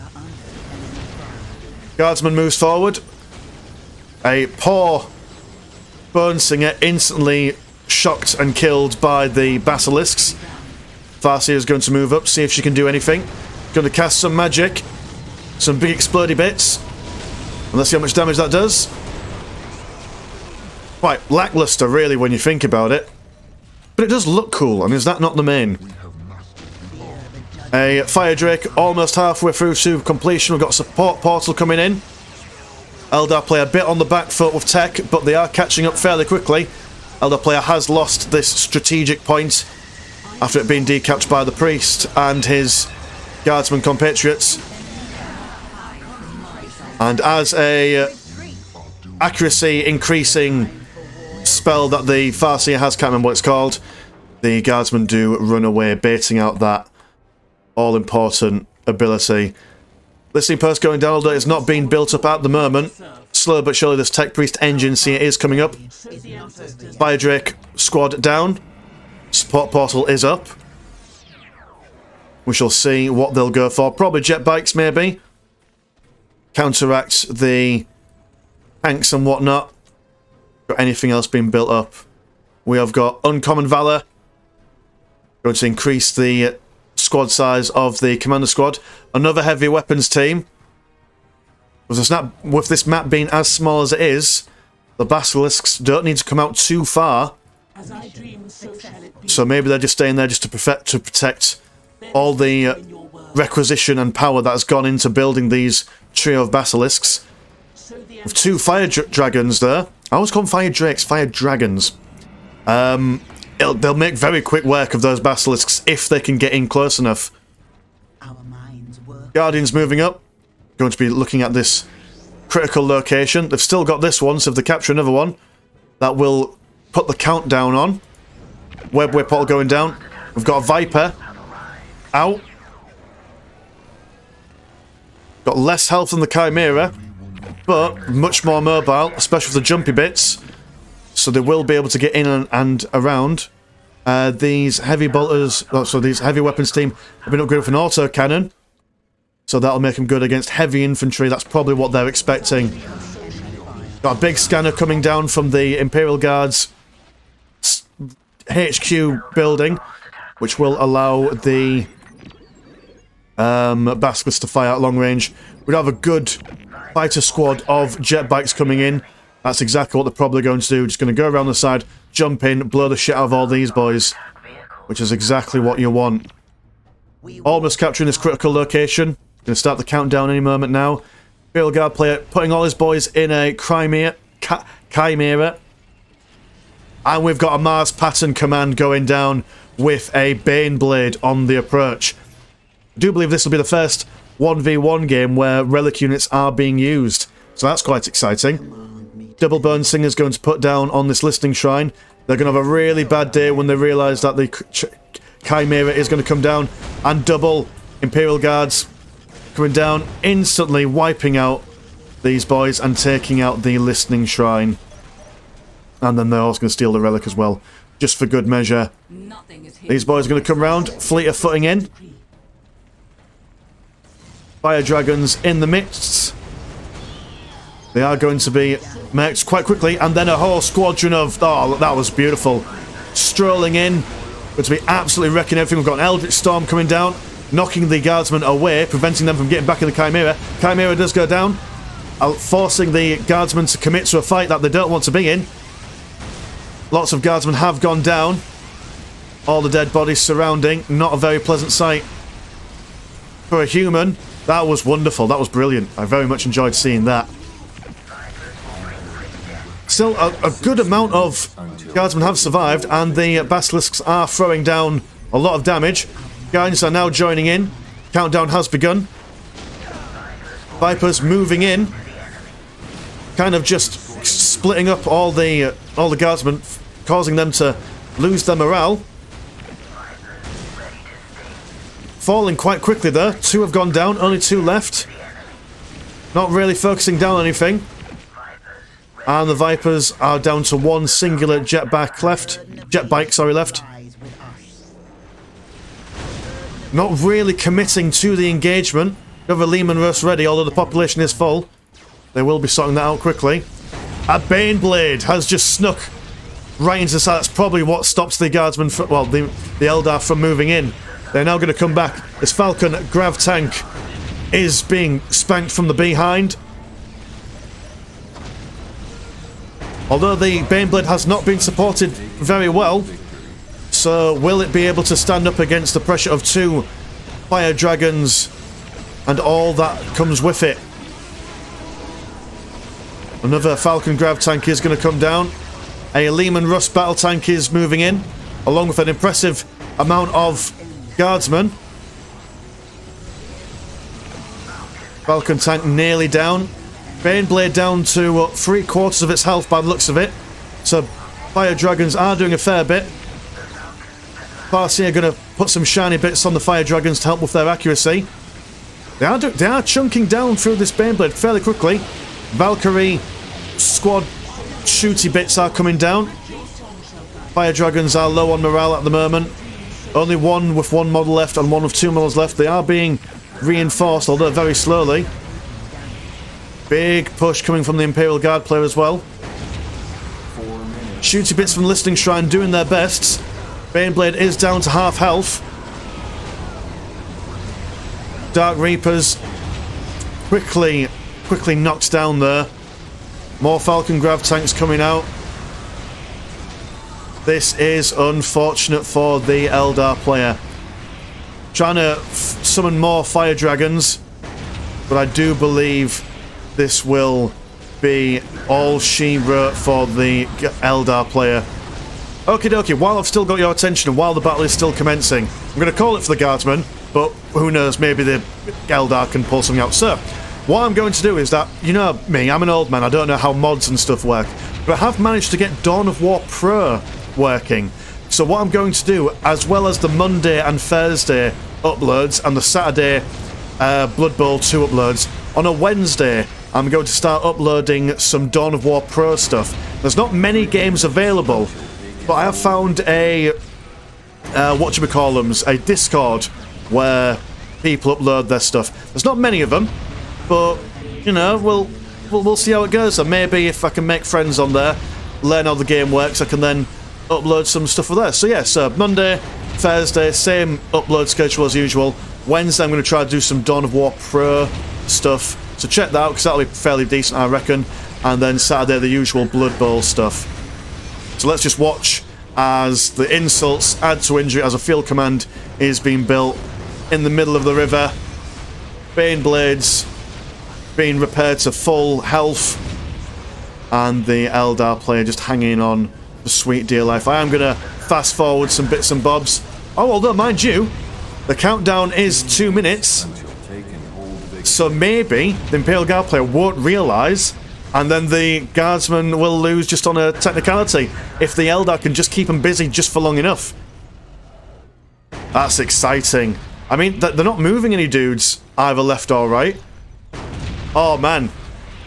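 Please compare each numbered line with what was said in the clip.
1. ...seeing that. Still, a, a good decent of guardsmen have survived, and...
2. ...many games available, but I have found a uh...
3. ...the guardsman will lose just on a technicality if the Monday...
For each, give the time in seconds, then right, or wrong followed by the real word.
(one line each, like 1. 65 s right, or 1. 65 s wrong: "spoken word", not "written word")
1. 256 s wrong: "amount", not "decent"
2. 440 s right
3. 498 s wrong: "Eldar", not "Monday".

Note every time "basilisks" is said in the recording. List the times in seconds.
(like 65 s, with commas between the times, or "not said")
9 s, 95 s, 106 s, 115 s, 263 s.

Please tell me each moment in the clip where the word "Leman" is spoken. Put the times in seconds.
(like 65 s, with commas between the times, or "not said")
299 s, 336 s.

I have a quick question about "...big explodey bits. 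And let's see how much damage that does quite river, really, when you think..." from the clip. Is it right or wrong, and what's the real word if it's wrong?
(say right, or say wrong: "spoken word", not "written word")
wrong: "lackluster", not "river".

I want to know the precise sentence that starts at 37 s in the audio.
Elder player has lost this strategic point after it being decapped by the priest and his guardsman compatriots.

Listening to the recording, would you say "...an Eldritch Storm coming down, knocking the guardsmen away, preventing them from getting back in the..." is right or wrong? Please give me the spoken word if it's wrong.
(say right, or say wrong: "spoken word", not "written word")
right.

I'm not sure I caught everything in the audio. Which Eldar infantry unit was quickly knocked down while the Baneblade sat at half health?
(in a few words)
Dark Reapers.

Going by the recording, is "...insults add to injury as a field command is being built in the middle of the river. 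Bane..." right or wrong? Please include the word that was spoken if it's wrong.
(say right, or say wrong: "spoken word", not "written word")
right.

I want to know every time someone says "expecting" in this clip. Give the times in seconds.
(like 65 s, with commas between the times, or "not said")
152 s.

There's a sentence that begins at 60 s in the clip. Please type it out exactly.
Listening post going down, although it's not being built up at the moment.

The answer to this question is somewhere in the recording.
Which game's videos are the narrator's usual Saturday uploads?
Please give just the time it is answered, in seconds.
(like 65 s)
434 s.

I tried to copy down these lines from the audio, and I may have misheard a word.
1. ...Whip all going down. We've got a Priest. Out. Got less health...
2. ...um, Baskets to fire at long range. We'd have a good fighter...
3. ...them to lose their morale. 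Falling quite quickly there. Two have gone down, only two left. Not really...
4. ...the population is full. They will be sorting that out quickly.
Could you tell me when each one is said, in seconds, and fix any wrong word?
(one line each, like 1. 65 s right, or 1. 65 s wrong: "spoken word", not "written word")
1. 129 s wrong: "Viper", not "Priest"
2. 163 s right
3. 277 s right
4. 300 s right.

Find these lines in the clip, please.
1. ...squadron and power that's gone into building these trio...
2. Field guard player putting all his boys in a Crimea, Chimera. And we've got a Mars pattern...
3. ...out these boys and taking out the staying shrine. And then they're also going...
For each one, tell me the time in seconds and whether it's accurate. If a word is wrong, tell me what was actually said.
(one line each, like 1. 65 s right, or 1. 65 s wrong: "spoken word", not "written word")
1. 103 s wrong: "requisition", not "squadron"
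2. 181 s right
3. 211 s wrong: "listening", not "staying".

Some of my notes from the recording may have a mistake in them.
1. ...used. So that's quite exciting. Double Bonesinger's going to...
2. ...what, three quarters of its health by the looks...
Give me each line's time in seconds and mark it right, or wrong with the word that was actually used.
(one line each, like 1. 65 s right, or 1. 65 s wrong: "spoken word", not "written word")
1. 196 s right
2. 348 s right.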